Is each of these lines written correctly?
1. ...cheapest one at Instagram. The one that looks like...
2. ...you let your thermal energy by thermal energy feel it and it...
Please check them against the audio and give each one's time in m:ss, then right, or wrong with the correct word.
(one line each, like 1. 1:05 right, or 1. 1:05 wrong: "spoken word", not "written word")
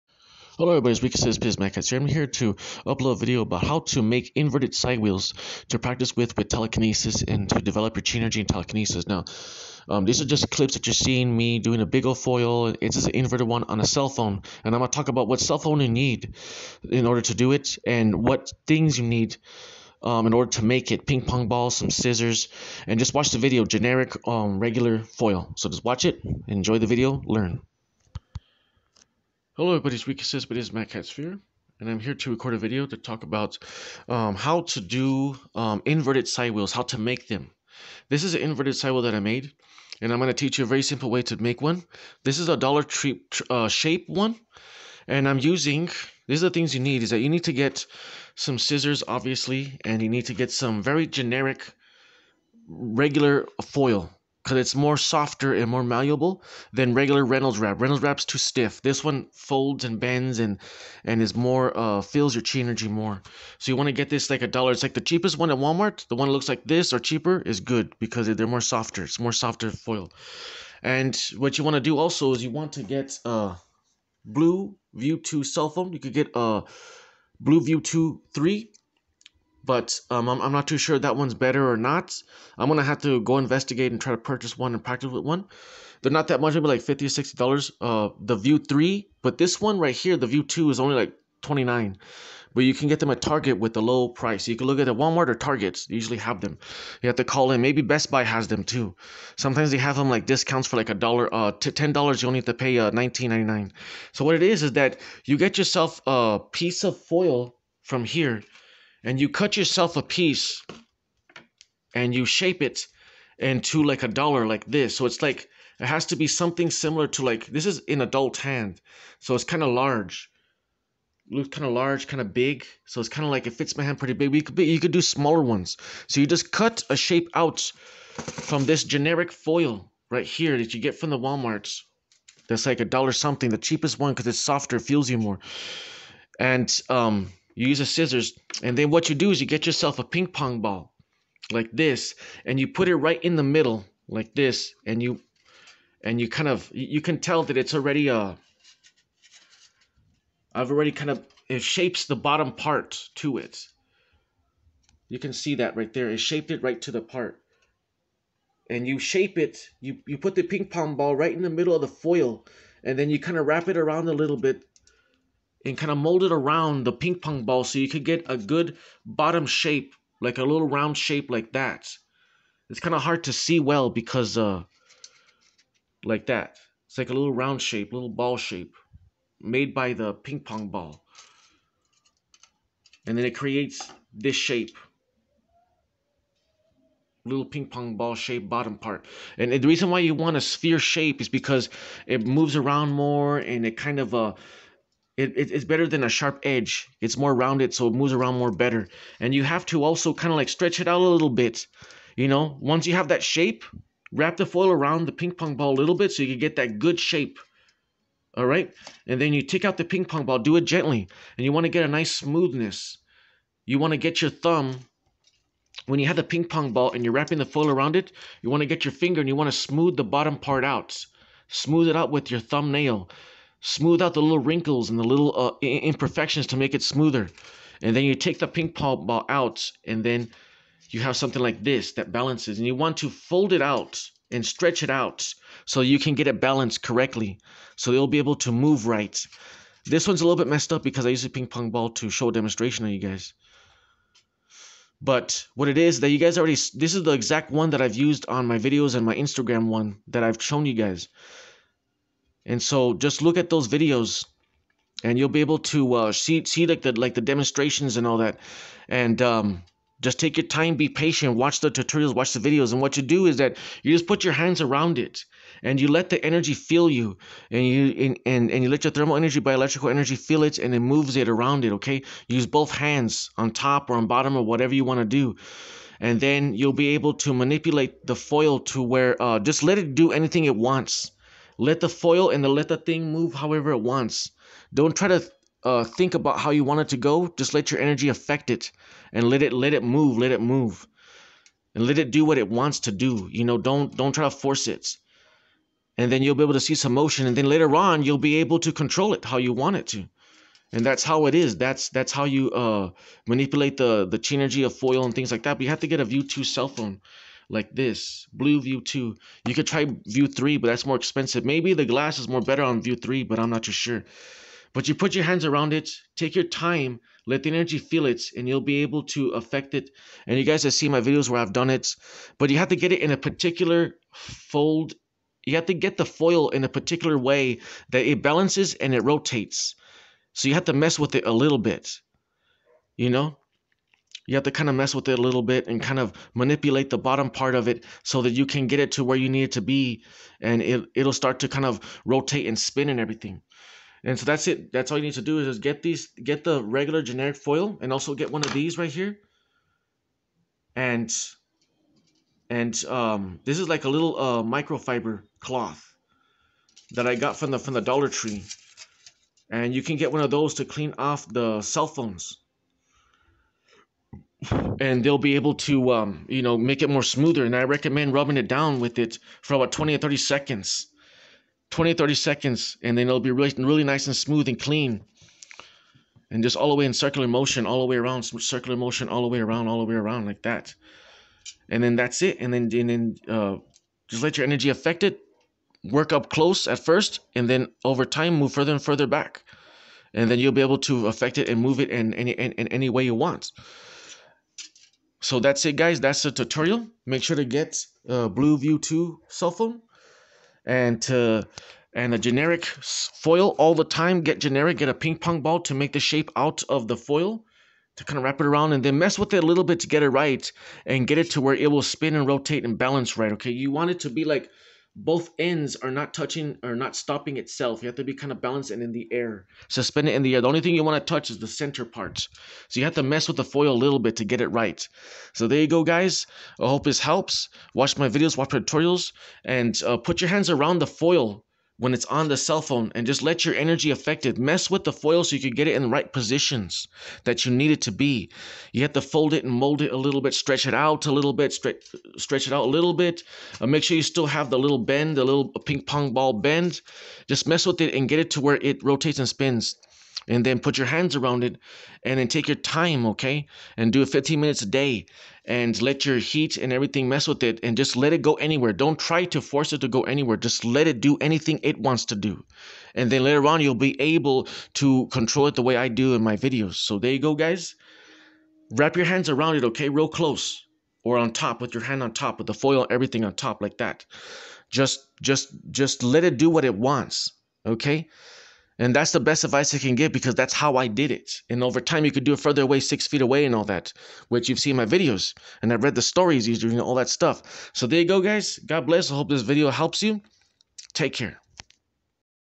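1. 1:05 wrong: "Walmart", not "Instagram"
2. 4:28 wrong: "electrical", not "thermal".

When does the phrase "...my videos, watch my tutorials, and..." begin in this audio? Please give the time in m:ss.
7:07.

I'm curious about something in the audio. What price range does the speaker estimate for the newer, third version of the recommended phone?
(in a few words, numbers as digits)
$50 to $60.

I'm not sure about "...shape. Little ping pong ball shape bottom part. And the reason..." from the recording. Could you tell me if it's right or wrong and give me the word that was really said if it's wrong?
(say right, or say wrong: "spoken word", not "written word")
right.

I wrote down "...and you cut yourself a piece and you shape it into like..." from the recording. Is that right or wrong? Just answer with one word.
right.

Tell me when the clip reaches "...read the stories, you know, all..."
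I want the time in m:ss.
8:05.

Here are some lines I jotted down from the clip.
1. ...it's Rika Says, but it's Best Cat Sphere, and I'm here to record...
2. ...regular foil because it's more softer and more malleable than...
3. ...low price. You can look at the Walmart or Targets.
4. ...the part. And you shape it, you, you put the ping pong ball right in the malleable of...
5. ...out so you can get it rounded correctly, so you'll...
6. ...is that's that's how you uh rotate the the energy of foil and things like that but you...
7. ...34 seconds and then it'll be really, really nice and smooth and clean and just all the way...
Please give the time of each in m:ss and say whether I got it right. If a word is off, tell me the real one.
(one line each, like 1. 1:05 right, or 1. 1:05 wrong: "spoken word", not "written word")
1. 0:29 wrong: "Mad", not "Best"
2. 0:52 right
3. 1:33 right
4. 2:36 wrong: "middle", not "malleable"
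5. 3:54 wrong: "balanced", not "rounded"
6. 5:01 wrong: "manipulate", not "rotate"
7. 6:11 wrong: "30", not "34".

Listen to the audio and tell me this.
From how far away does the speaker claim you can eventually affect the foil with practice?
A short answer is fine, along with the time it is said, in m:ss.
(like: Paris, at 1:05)
6 feet, at 8:02.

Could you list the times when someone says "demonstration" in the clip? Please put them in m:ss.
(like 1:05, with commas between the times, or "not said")
4:02, 4:17.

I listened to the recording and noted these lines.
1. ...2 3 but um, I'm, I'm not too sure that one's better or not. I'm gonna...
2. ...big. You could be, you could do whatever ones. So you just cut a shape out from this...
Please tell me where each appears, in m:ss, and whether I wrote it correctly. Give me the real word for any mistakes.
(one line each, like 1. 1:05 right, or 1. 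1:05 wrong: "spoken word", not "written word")
1. 1:17 right
2. 2:04 wrong: "smaller", not "whatever".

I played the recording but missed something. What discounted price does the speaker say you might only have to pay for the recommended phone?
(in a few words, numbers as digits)
$19.99.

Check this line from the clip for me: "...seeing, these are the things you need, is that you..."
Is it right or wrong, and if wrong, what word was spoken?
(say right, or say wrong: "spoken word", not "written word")
wrong: "using", not "seeing".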